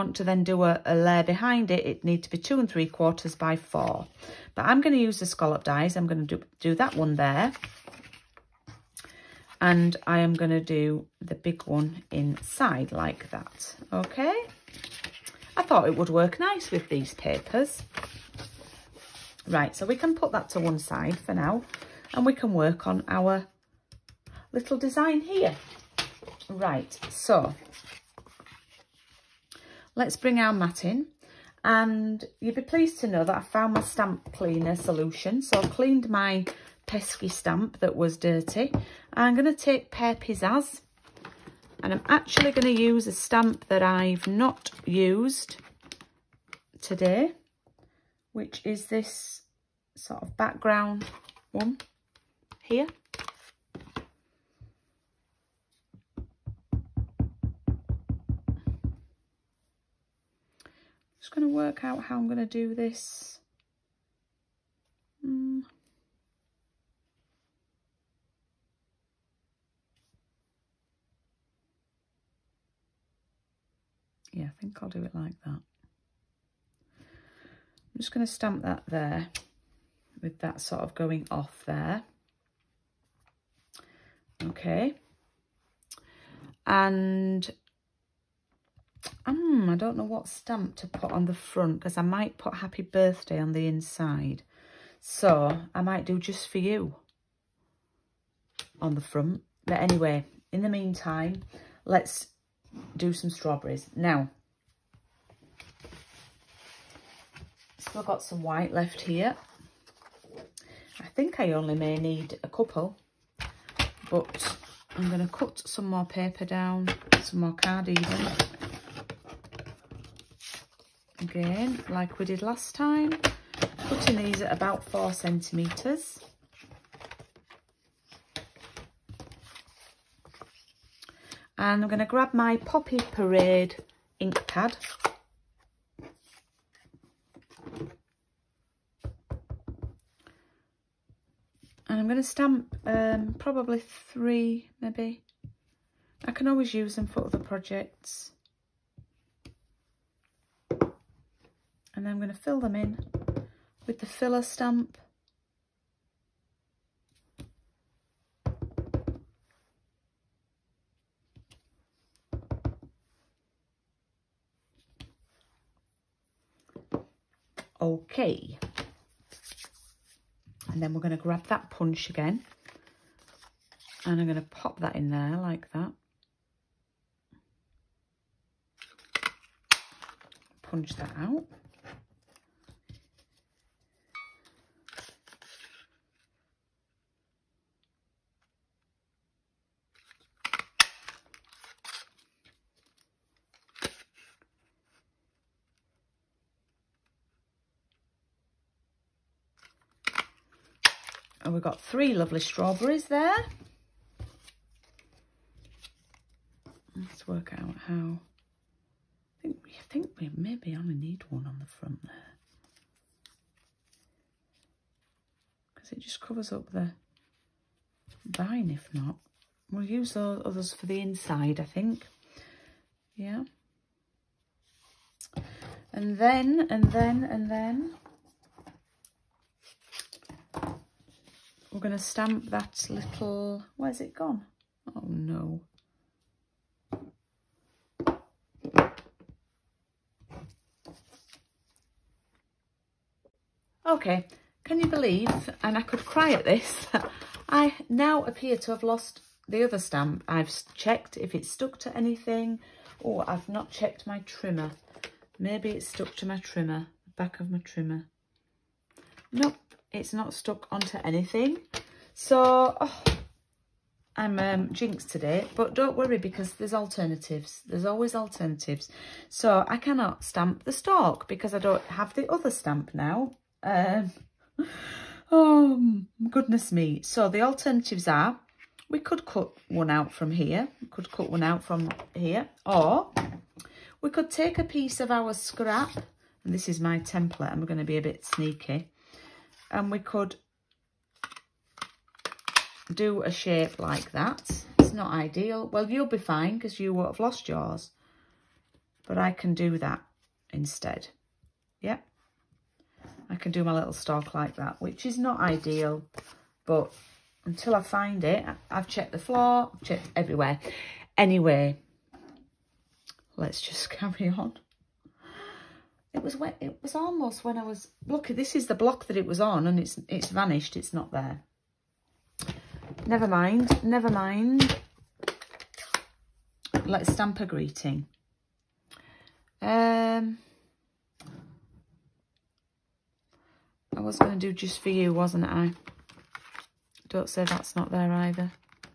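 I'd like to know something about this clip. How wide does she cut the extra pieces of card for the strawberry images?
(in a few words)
4 centimeters.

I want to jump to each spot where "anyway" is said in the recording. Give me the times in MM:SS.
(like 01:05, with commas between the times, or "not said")
01:39, 05:11.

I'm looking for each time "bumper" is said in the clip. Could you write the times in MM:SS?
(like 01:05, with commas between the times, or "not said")
not said.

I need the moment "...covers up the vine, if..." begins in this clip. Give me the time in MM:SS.
03:36.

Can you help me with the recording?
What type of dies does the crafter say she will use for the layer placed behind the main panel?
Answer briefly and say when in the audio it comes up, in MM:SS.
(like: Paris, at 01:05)
Scallop dies, at 00:05.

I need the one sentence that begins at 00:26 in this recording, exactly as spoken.
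Right, so Let's bring our mat in.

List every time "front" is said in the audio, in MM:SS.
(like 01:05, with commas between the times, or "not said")
01:31, 01:38, 03:31.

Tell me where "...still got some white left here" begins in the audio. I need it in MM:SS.
01:47.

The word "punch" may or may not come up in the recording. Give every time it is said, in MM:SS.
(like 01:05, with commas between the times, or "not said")
02:51, 03:00.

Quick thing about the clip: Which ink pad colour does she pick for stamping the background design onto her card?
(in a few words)
Pear Pizzazz.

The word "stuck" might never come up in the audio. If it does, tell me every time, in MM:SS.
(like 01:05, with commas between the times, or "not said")
04:11, 04:15, 04:20.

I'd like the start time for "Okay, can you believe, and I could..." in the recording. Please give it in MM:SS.
04:03.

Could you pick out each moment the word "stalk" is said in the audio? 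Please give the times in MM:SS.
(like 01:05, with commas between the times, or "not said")
04:30, 05:03.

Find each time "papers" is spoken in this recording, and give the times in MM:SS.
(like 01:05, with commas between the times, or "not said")
00:17, 01:56.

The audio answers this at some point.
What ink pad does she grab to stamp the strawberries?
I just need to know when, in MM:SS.
02:12.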